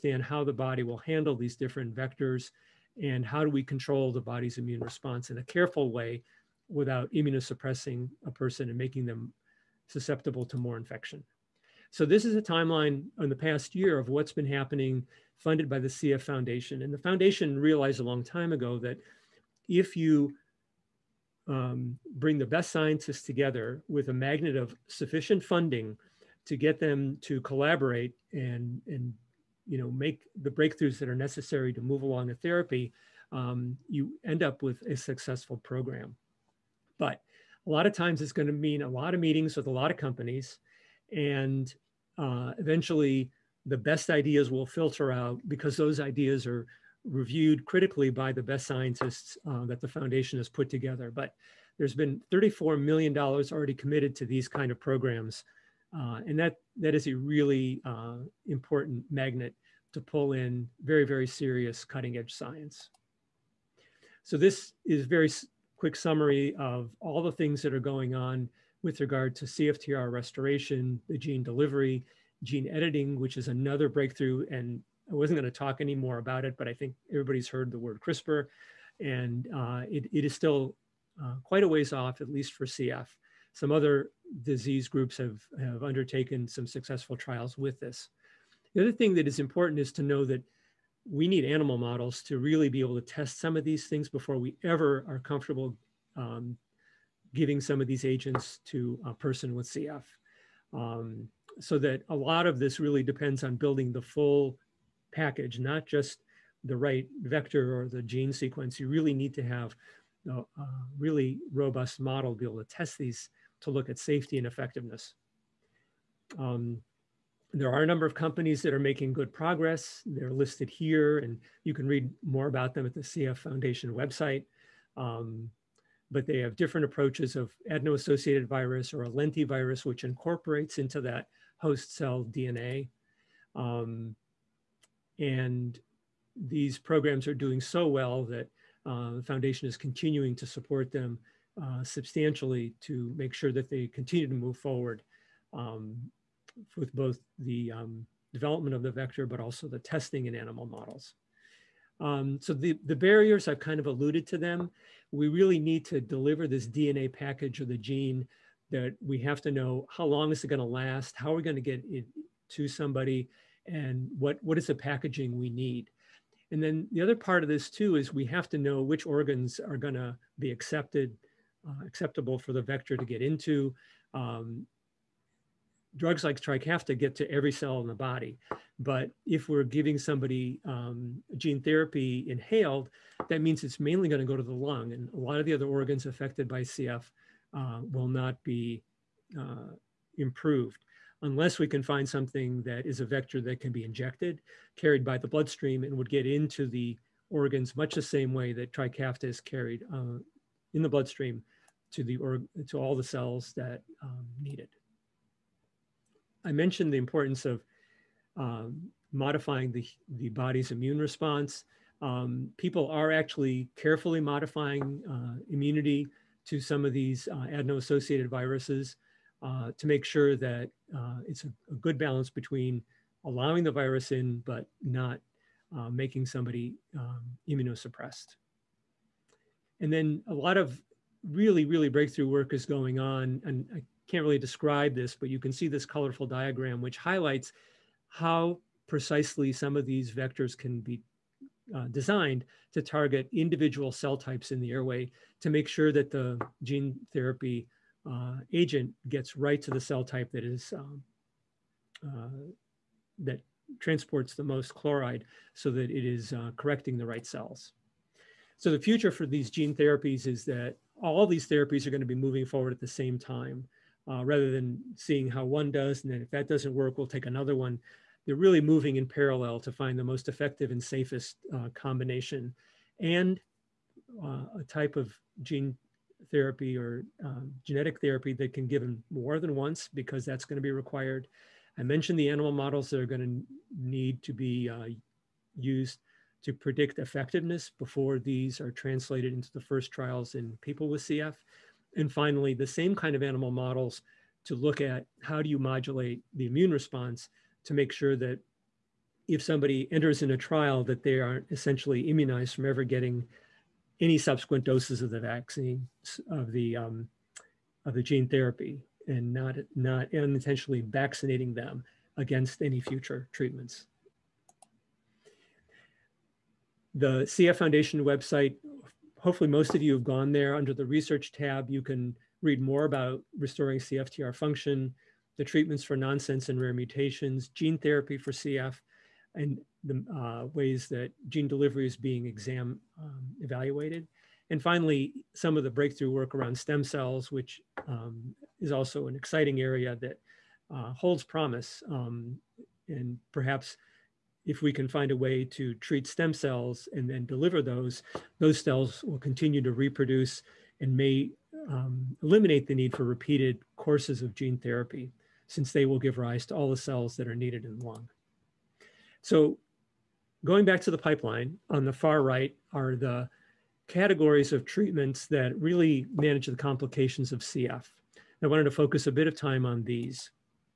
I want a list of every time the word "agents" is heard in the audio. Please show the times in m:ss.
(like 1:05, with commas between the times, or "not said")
1:38, 4:08.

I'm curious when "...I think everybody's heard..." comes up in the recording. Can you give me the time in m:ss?
1:16.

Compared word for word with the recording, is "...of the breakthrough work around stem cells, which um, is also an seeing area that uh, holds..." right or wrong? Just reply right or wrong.
wrong.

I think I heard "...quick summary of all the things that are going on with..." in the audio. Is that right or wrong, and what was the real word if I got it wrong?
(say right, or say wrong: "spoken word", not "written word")
right.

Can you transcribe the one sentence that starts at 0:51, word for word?
But there's been $34 million already committed to these kind of programs.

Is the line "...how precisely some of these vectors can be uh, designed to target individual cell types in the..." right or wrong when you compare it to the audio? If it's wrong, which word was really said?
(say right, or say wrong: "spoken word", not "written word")
right.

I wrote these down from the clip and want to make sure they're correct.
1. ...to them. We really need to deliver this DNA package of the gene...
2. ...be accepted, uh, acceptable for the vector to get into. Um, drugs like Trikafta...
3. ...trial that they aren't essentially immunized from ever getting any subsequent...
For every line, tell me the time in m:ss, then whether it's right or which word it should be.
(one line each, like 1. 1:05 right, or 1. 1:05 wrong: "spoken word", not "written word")
1. 2:34 right
2. 2:50 right
3. 5:00 right.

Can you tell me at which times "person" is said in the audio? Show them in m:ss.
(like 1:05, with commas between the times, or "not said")
0:08, 1:39.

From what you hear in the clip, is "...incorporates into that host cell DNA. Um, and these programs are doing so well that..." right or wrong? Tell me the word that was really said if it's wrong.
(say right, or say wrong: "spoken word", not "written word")
right.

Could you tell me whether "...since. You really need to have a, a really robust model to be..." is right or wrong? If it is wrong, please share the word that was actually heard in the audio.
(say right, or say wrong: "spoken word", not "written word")
wrong: "sequence", not "since".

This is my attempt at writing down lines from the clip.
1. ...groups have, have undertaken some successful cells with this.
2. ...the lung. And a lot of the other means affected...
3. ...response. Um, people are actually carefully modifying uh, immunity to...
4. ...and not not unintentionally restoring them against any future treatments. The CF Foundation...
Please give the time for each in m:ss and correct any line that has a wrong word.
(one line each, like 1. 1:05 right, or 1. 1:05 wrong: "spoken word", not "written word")
1. 1:24 wrong: "trials", not "cells"
2. 3:04 wrong: "organs", not "means"
3. 3:30 right
4. 5:09 wrong: "vaccinating", not "restoring".